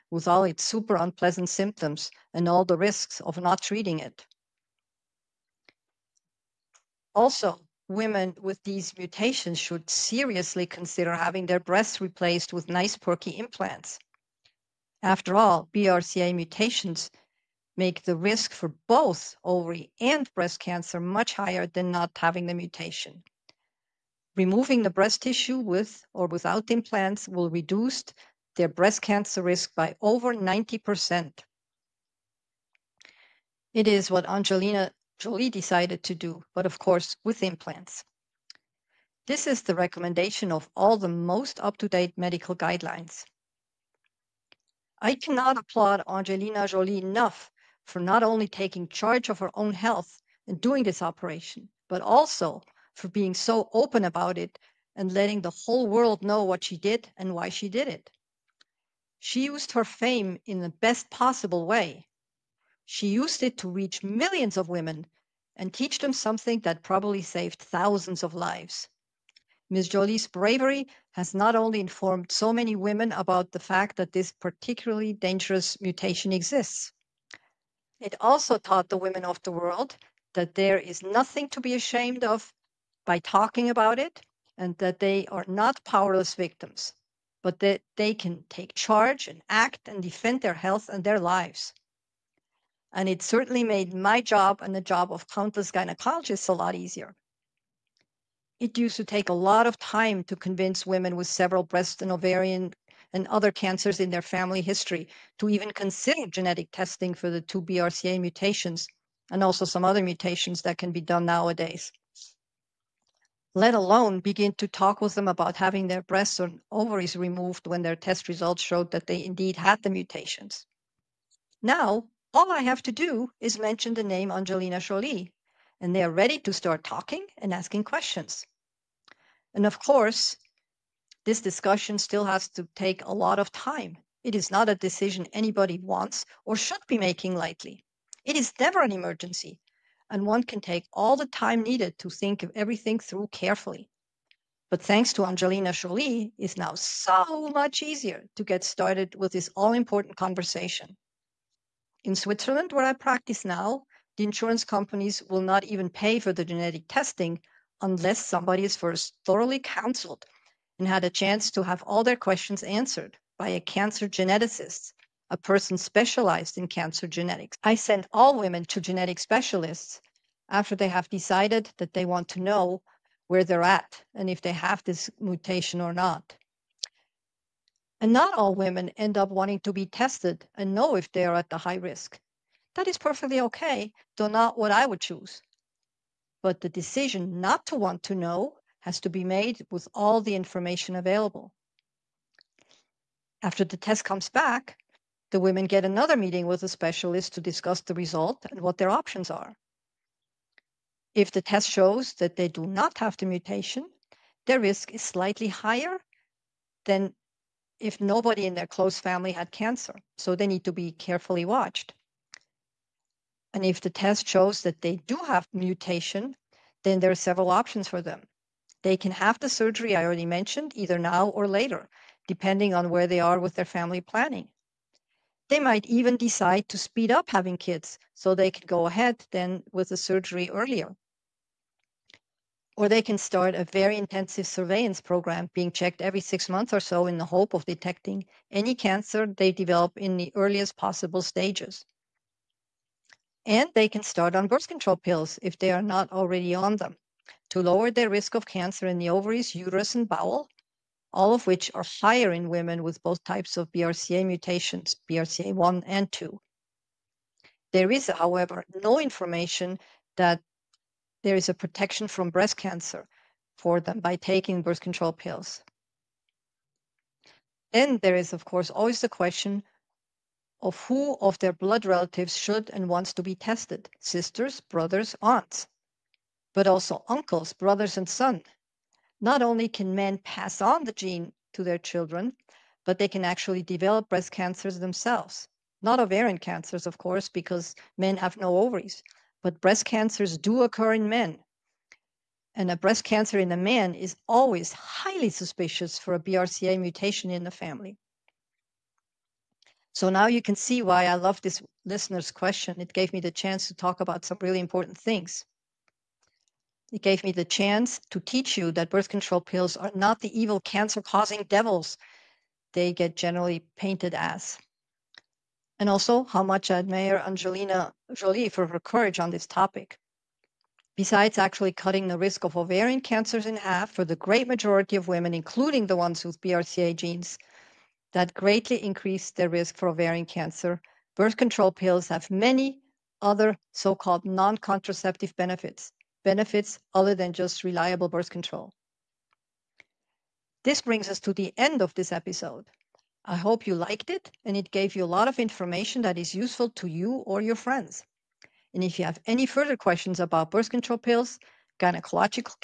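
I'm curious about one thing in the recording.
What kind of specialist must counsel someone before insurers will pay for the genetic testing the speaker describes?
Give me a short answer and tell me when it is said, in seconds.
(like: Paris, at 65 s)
cancer geneticist, at 163 s.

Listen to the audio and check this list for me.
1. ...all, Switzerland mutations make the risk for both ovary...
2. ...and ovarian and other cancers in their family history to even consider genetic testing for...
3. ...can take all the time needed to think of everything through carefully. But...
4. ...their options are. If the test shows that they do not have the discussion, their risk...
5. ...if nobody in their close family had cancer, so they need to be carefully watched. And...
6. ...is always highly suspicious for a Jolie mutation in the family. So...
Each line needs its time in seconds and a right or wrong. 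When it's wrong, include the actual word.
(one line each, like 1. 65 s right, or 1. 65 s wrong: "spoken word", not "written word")
1. 15 s wrong: "BRCA", not "Switzerland"
2. 102 s right
3. 140 s right
4. 198 s wrong: "mutation", not "discussion"
5. 207 s right
6. 293 s wrong: "BRCA", not "Jolie".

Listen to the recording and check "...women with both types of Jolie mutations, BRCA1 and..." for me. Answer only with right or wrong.
wrong.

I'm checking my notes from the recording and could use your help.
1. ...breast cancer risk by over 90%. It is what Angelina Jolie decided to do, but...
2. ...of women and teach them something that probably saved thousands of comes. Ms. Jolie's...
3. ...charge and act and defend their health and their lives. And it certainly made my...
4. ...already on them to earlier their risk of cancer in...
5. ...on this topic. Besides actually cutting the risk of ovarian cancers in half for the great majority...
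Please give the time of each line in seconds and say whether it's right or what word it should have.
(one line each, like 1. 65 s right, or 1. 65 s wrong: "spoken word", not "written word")
1. 28 s right
2. 64 s wrong: "lives", not "comes"
3. 88 s right
4. 246 s wrong: "lower", not "earlier"
5. 319 s right.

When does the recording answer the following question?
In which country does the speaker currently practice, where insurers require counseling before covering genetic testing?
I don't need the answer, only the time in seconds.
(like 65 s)
152 s.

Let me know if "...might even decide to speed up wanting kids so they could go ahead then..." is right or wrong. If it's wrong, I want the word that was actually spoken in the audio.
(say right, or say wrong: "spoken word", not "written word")
wrong: "having", not "wanting".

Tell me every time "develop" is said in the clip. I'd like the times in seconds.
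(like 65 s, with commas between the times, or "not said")
239 s, 283 s.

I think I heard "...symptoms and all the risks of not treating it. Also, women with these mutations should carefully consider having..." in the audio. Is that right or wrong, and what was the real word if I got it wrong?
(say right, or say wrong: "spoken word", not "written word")
wrong: "seriously", not "carefully".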